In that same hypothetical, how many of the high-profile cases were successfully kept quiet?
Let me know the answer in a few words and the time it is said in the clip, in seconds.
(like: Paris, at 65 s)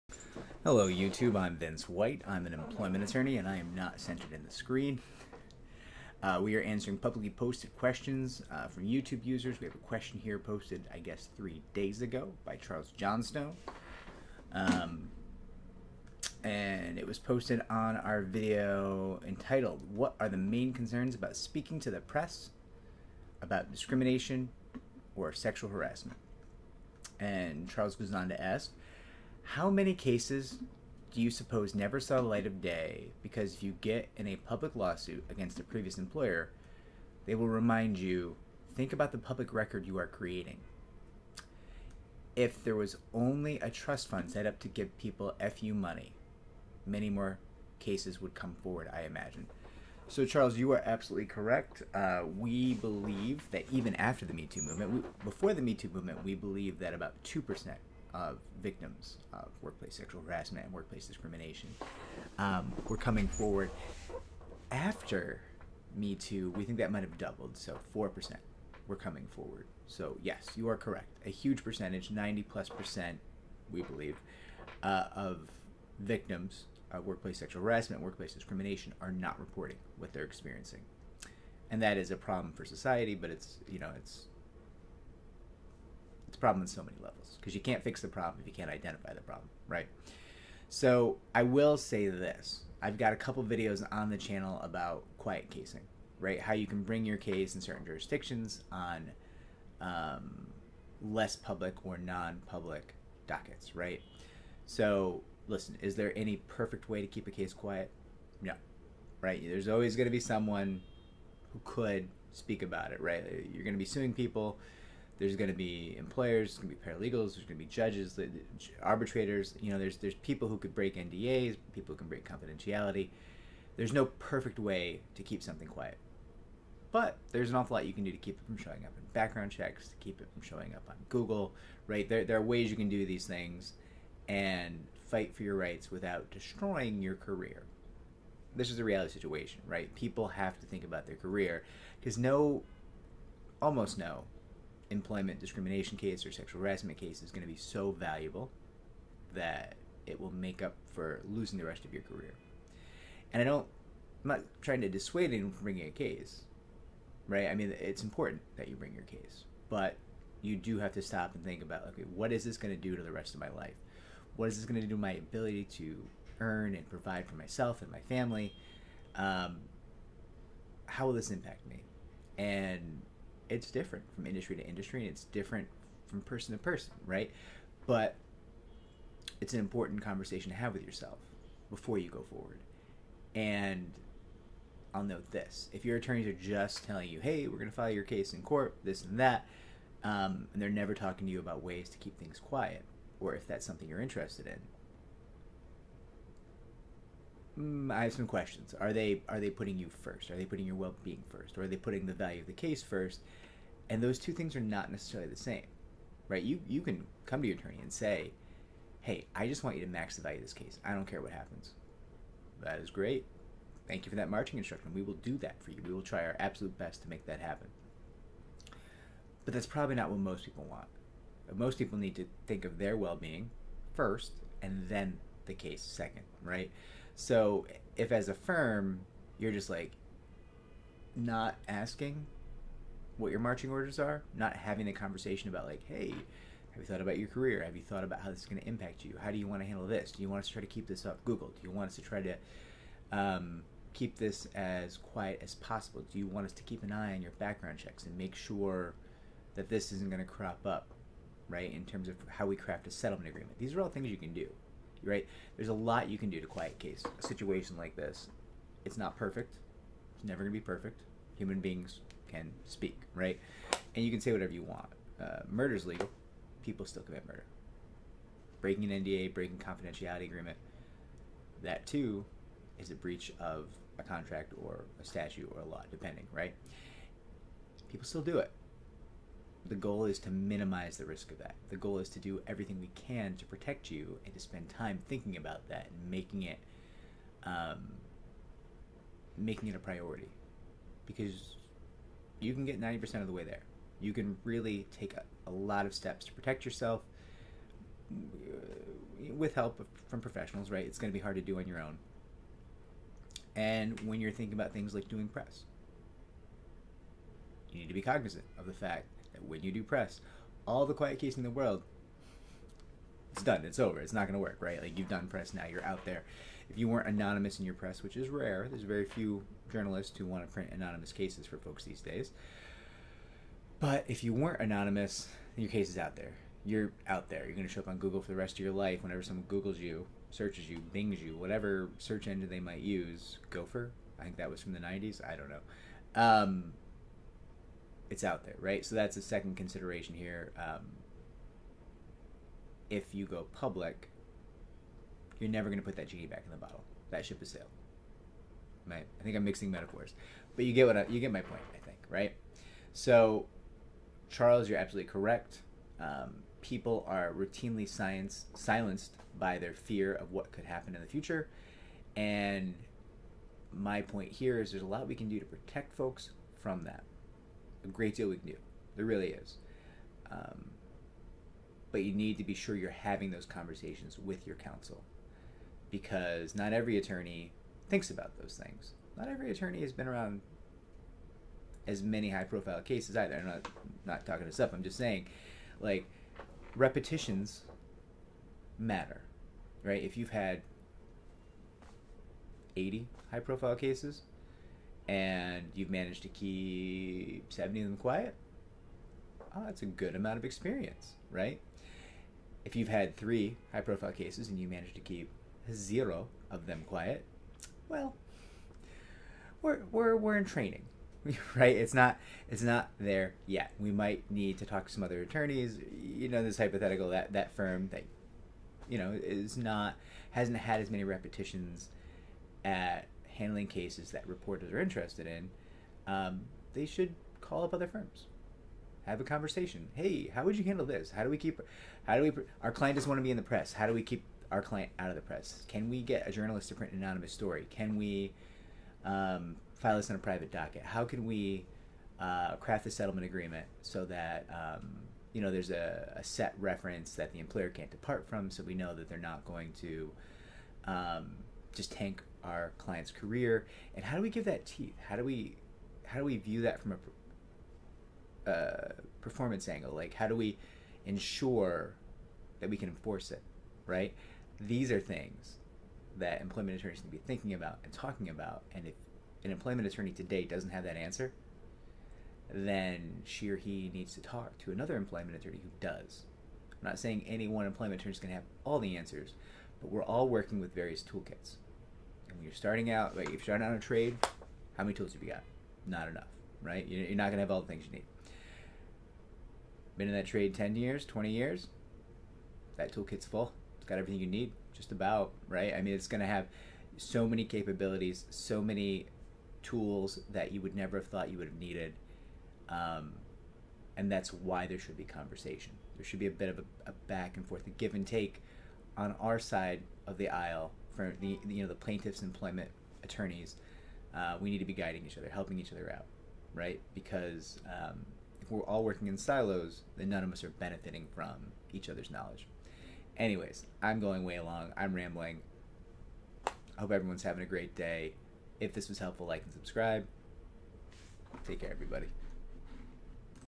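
70, at 397 s.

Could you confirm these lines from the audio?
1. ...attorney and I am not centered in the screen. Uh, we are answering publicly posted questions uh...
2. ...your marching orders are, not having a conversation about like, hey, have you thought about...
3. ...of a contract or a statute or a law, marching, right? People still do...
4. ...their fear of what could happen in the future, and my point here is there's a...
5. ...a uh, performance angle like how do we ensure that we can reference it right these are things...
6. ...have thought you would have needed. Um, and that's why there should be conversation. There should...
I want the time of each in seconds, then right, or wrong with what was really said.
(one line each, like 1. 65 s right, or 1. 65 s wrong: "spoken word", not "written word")
1. 3 s right
2. 233 s right
3. 273 s wrong: "depending", not "marching"
4. 359 s right
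5. 458 s wrong: "enforce", not "reference"
6. 500 s right.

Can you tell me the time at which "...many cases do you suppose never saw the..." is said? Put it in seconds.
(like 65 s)
29 s.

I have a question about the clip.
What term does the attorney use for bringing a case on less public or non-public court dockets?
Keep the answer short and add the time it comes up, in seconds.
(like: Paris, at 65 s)
quiet casing, at 95 s.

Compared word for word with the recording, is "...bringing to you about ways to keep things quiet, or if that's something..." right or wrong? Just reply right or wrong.
wrong.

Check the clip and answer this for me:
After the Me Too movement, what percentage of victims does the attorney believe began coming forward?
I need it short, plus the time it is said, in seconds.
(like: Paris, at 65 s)
4%, at 67 s.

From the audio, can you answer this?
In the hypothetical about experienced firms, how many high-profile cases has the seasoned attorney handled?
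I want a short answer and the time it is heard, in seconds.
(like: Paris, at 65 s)
80, at 392 s.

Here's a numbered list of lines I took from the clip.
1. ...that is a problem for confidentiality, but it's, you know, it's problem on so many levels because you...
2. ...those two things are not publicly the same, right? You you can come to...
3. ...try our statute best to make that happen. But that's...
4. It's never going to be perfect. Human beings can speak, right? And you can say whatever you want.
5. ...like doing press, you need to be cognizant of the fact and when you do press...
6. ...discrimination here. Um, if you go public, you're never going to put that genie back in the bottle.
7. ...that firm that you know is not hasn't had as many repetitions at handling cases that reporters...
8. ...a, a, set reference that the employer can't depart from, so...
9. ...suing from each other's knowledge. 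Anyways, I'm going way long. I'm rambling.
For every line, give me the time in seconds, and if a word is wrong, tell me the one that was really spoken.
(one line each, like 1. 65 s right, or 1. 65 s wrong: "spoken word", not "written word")
1. 81 s wrong: "society", not "confidentiality"
2. 204 s wrong: "necessarily", not "publicly"
3. 216 s wrong: "absolute", not "statute"
4. 260 s right
5. 304 s right
6. 339 s wrong: "consideration", not "discrimination"
7. 417 s right
8. 445 s right
9. 520 s wrong: "benefiting", not "suing".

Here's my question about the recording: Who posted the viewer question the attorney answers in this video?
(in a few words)
Charles Johnstone.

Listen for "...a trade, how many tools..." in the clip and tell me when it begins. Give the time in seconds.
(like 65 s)
483 s.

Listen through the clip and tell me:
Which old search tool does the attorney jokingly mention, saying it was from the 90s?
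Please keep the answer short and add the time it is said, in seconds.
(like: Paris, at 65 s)
Gopher, at 333 s.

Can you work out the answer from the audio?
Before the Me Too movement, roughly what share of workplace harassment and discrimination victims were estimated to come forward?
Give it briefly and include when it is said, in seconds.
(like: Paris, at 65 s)
2%, at 57 s.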